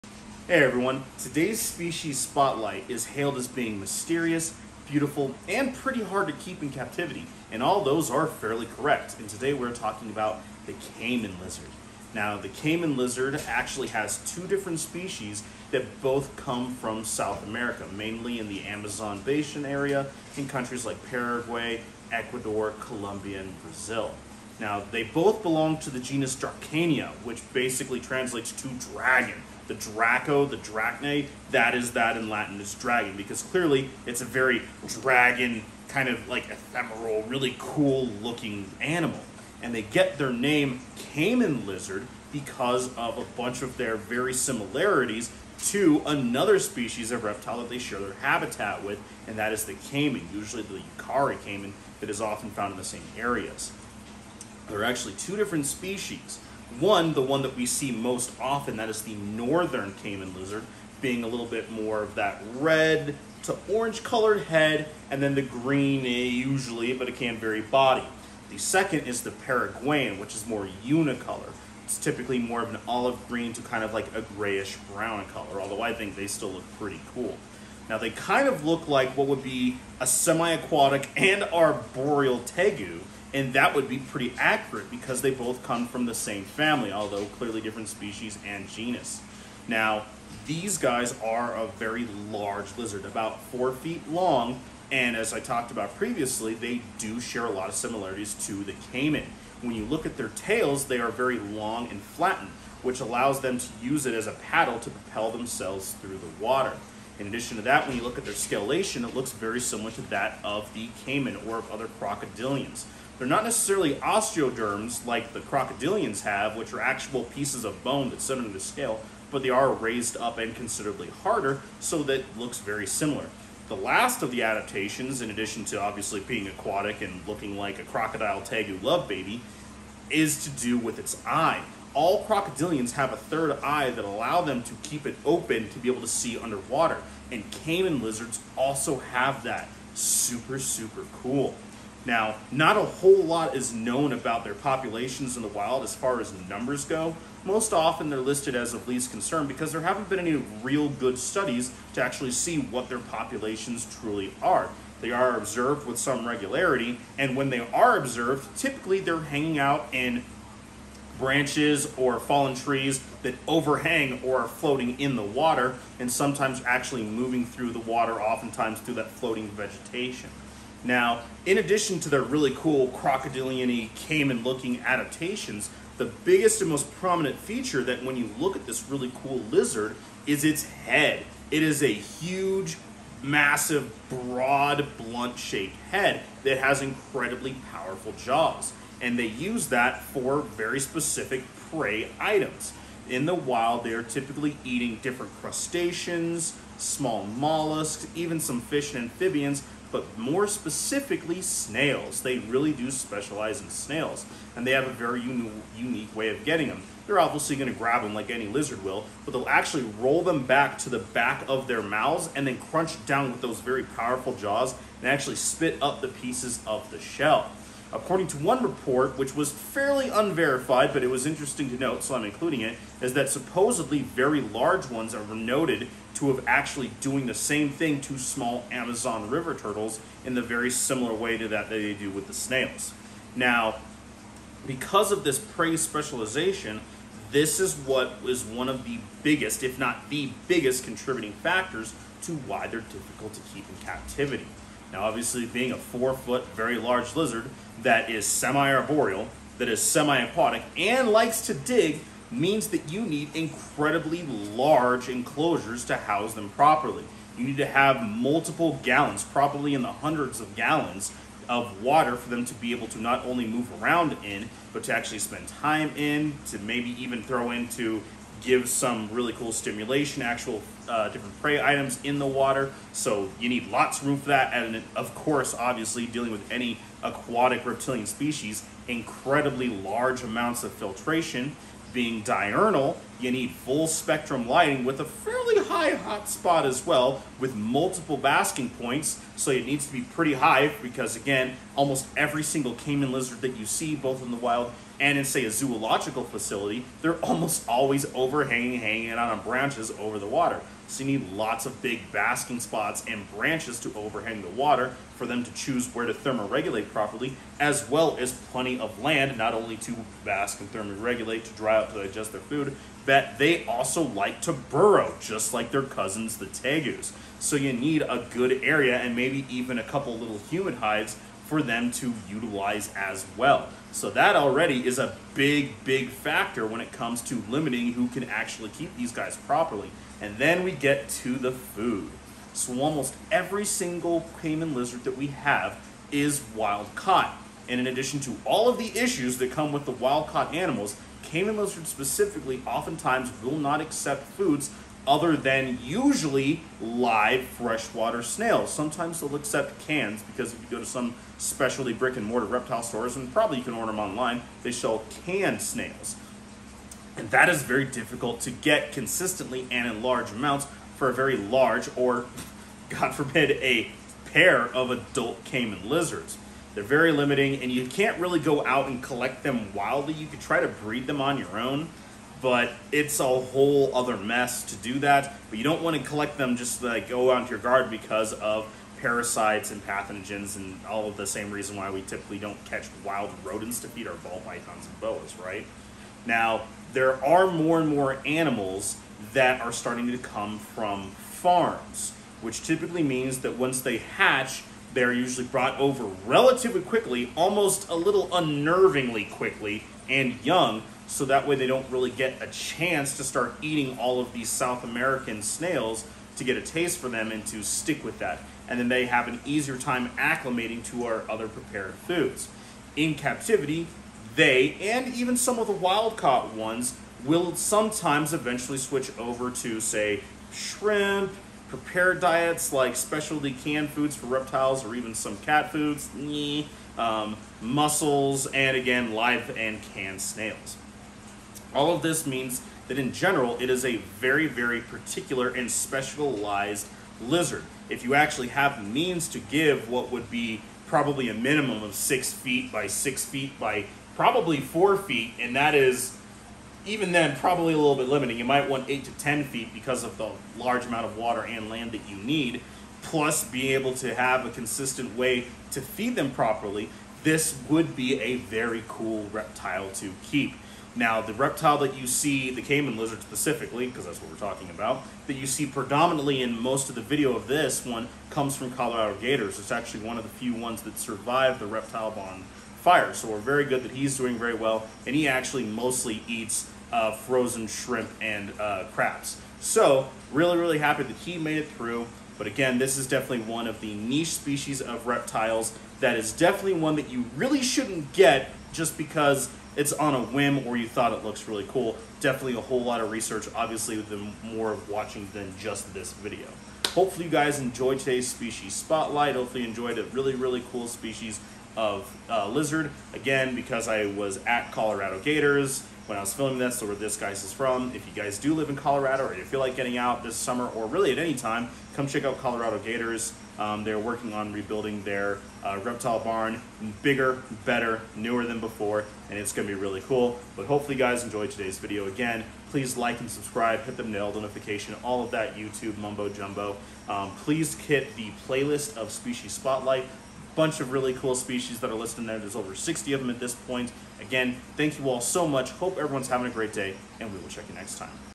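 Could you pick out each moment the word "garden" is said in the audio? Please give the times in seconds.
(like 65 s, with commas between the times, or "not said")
377 s.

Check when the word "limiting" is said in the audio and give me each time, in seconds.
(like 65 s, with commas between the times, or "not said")
327 s, 367 s, 448 s.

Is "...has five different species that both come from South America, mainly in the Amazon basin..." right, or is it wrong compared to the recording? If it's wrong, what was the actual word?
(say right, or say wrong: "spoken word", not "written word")
wrong: "two", not "five".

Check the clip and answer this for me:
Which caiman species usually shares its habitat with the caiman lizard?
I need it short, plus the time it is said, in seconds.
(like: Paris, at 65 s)
Yacare caiman, at 50 s.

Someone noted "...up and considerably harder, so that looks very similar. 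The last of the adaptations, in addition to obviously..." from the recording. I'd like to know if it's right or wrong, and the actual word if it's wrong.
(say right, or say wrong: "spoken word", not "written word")
right.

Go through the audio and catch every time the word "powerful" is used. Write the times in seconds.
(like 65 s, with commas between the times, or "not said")
187 s, 213 s.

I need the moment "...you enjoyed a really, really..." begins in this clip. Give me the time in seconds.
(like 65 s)
499 s.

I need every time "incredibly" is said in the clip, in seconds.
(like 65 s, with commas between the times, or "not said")
186 s, 253 s, 278 s.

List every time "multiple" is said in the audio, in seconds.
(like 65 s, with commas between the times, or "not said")
258 s, 287 s.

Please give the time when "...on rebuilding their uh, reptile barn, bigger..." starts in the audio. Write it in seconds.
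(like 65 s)
514 s.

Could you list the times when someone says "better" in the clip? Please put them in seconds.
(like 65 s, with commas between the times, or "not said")
517 s.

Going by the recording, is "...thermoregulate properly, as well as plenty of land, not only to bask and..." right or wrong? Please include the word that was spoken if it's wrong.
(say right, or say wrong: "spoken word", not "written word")
right.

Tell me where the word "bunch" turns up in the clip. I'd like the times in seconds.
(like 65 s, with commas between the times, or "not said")
43 s, 530 s.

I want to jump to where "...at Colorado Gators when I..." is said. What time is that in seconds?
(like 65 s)
504 s.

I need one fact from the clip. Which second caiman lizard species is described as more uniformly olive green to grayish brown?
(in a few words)
Paraguayan.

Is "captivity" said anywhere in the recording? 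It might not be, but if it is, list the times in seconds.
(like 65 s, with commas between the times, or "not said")
6 s, 243 s, 413 s.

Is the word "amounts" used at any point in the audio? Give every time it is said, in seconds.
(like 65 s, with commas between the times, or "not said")
280 s, 360 s, 450 s.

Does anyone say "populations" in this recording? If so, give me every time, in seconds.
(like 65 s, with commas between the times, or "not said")
144 s, 152 s.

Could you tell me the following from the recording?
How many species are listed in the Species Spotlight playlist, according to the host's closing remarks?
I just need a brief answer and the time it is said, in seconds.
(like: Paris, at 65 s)
over 60, at 532 s.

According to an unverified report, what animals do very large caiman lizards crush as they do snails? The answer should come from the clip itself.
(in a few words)
Small Amazon river turtles.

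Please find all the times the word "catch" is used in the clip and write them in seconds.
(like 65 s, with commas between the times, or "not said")
382 s.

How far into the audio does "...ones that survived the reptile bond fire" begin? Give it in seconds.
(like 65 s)
470 s.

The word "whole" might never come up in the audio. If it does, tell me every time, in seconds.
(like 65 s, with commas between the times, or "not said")
142 s, 373 s, 492 s.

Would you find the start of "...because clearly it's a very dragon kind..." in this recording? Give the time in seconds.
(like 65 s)
33 s.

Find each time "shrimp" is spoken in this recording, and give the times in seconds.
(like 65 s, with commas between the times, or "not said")
420 s, 477 s.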